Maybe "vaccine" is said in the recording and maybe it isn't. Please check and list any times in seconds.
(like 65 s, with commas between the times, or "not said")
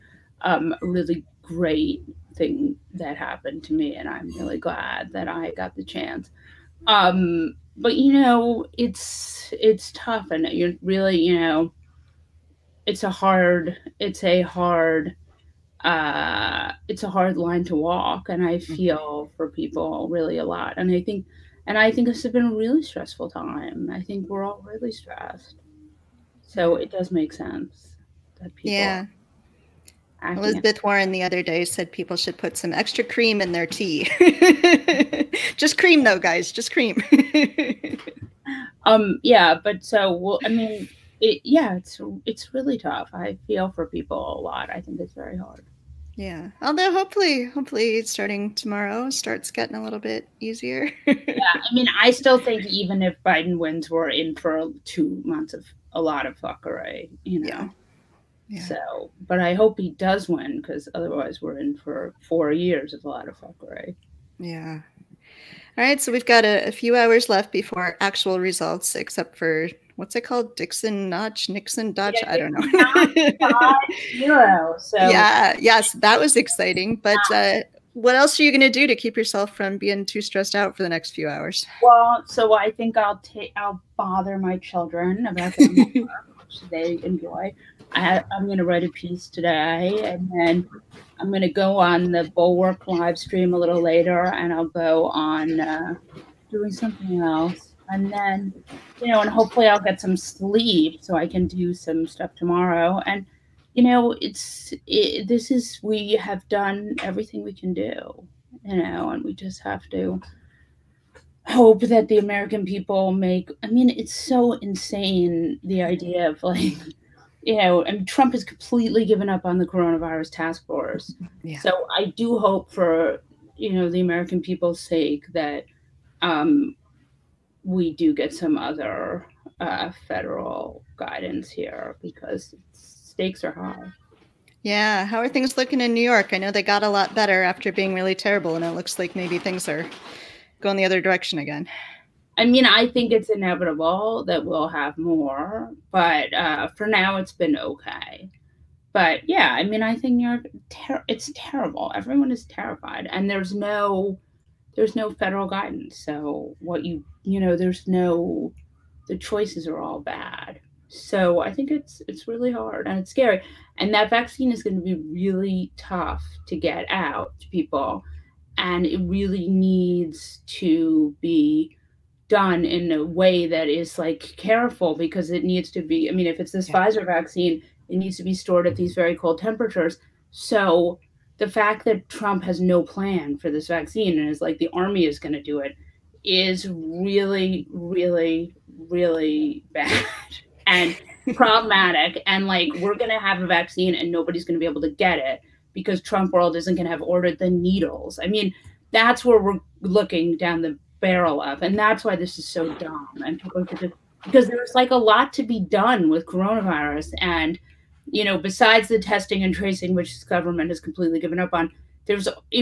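164 s, 177 s, 183 s, 193 s.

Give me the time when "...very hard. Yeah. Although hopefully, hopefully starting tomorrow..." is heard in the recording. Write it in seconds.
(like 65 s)
45 s.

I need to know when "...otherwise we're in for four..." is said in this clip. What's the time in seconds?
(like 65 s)
60 s.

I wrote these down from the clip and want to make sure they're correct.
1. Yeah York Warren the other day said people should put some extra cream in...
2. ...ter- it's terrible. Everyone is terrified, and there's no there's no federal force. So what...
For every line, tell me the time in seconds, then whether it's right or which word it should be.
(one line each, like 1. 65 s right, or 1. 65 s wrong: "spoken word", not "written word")
1. 28 s wrong: "Elizabeth", not "York"
2. 150 s wrong: "guidance", not "force".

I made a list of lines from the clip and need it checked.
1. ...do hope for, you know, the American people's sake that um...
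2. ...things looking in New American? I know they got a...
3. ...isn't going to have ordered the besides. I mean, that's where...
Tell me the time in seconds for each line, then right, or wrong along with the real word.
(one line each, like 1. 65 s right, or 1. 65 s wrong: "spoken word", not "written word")
1. 122 s right
2. 135 s wrong: "York", not "American"
3. 196 s wrong: "needles", not "besides".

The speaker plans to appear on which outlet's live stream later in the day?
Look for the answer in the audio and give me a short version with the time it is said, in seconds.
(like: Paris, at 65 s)
The Bulwark, at 92 s.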